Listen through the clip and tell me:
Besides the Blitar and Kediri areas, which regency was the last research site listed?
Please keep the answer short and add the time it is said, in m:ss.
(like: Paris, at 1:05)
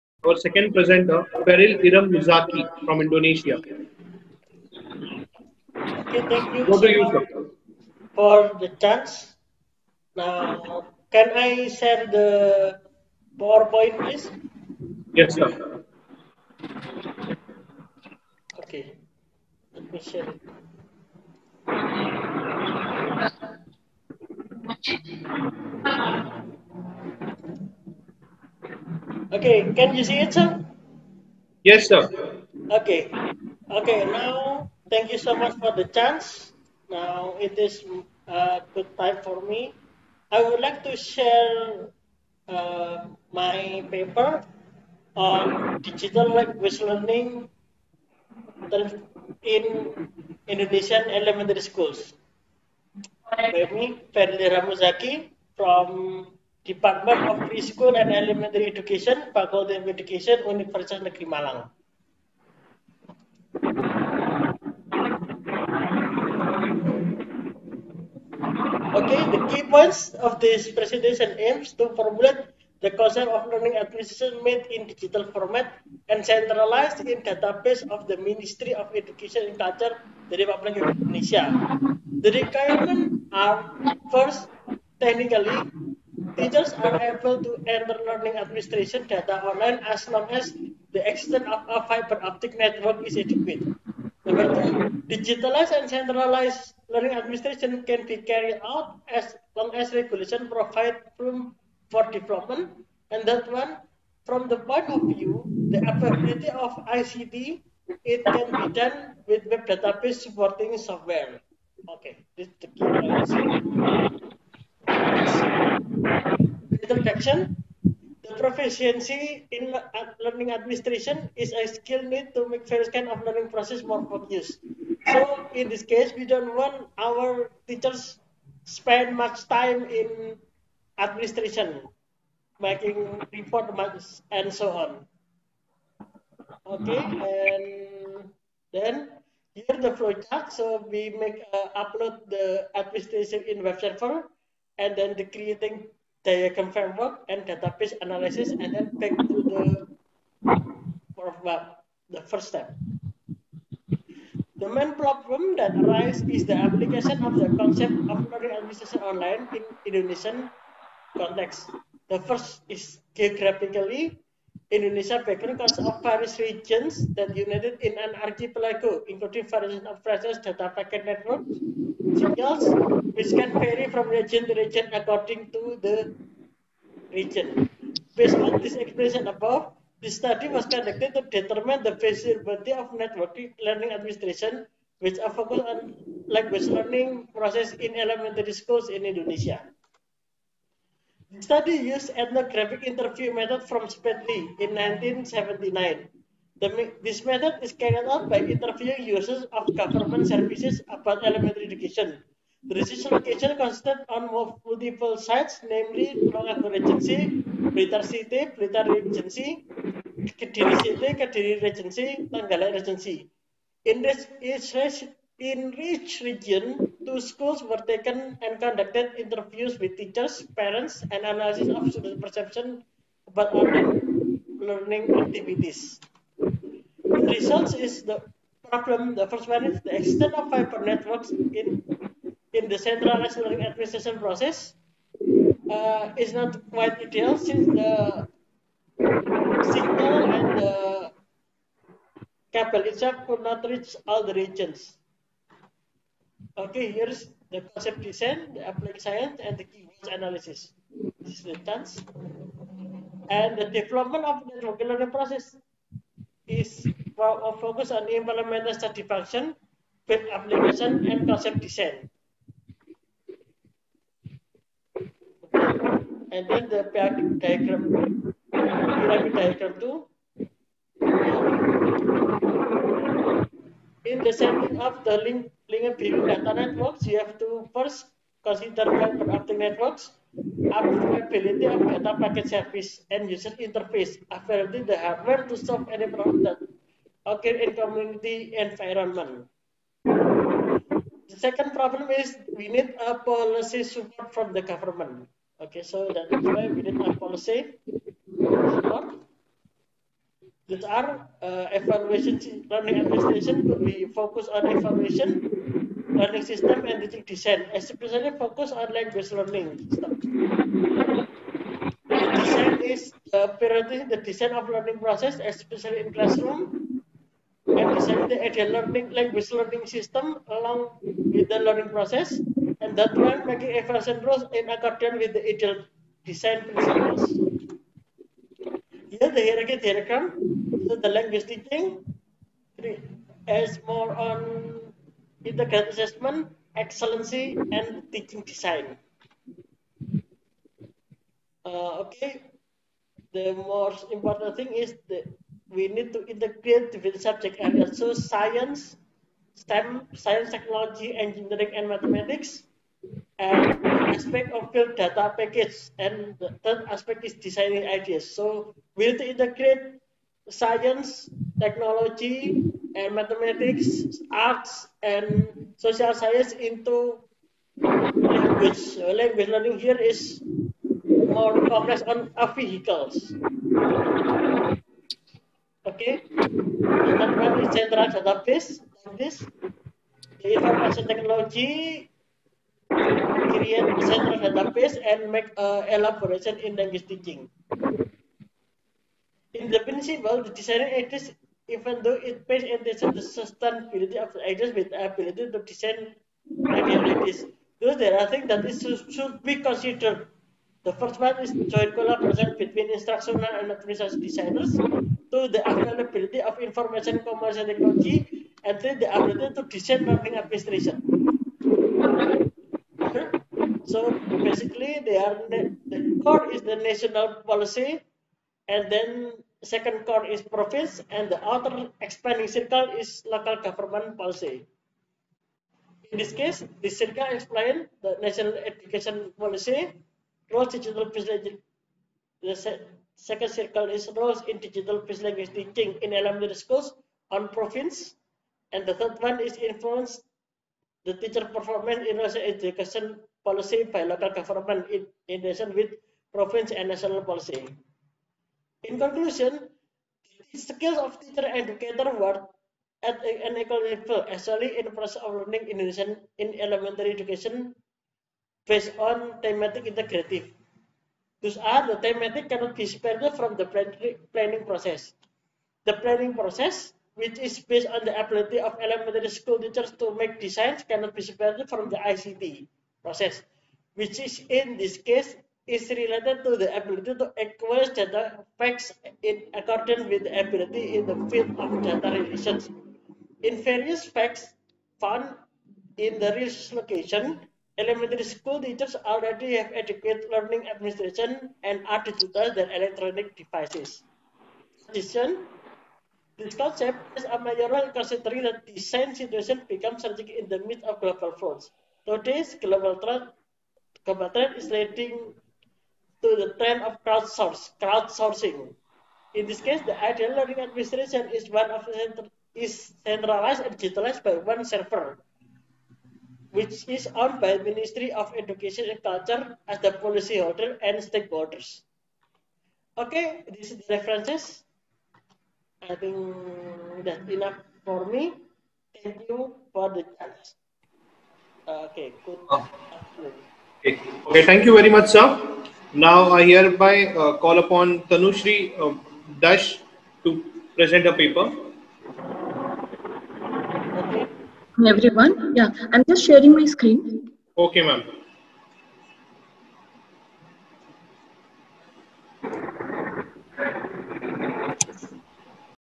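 Trenggalek Regency, at 3:32.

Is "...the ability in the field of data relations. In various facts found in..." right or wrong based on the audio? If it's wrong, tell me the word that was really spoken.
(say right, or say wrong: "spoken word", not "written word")
right.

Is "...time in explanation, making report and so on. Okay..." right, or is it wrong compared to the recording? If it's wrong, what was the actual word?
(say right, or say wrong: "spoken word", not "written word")
wrong: "administration", not "explanation".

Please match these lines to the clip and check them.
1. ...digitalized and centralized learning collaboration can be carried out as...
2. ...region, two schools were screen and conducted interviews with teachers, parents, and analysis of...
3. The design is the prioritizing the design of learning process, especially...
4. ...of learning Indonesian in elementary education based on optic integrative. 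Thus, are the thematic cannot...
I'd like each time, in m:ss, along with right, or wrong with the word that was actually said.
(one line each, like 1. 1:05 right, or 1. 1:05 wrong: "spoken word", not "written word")
1. 1:35 wrong: "administration", not "collaboration"
2. 3:36 wrong: "taken", not "screen"
3. 5:12 right
4. 7:35 wrong: "thematic", not "optic".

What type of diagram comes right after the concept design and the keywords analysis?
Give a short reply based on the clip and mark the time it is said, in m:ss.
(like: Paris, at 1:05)
pyramid diagram, at 4:28.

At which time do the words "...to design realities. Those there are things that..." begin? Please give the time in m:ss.
6:35.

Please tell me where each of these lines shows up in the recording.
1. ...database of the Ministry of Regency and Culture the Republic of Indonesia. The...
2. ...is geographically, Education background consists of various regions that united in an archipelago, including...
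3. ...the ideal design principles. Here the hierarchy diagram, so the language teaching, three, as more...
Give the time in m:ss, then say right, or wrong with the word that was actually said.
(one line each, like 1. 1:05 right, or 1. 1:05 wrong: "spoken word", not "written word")
1. 1:17 wrong: "Education", not "Regency"
2. 2:42 wrong: "Indonesia", not "Education"
3. 5:25 right.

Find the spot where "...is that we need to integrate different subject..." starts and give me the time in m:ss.
5:44.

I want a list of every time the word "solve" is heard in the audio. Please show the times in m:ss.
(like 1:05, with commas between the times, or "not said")
4:45.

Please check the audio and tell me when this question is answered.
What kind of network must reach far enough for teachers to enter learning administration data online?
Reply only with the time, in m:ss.
1:31.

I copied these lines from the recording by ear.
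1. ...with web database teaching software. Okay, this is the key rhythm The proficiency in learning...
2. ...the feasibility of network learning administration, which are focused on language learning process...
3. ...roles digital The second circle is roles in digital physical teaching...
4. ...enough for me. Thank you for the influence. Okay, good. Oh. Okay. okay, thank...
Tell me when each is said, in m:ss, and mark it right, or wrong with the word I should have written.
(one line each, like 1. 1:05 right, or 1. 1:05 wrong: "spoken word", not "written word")
1. 1:49 wrong: "supporting", not "teaching"
2. 3:01 right
3. 7:10 right
4. 8:47 wrong: "chance", not "influence".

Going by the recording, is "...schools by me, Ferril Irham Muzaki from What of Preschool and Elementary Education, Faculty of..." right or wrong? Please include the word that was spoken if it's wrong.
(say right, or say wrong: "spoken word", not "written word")
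wrong: "Department", not "What".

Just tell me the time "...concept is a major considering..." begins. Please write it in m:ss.
8:16.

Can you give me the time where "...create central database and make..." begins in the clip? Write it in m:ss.
6:23.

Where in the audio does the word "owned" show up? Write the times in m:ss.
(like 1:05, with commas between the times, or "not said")
8:37.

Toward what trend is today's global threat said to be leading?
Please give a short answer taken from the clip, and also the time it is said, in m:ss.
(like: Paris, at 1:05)
crowdsourcing, at 8:27.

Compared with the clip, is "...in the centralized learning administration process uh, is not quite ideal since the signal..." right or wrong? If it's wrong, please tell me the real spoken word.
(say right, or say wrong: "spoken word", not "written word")
right.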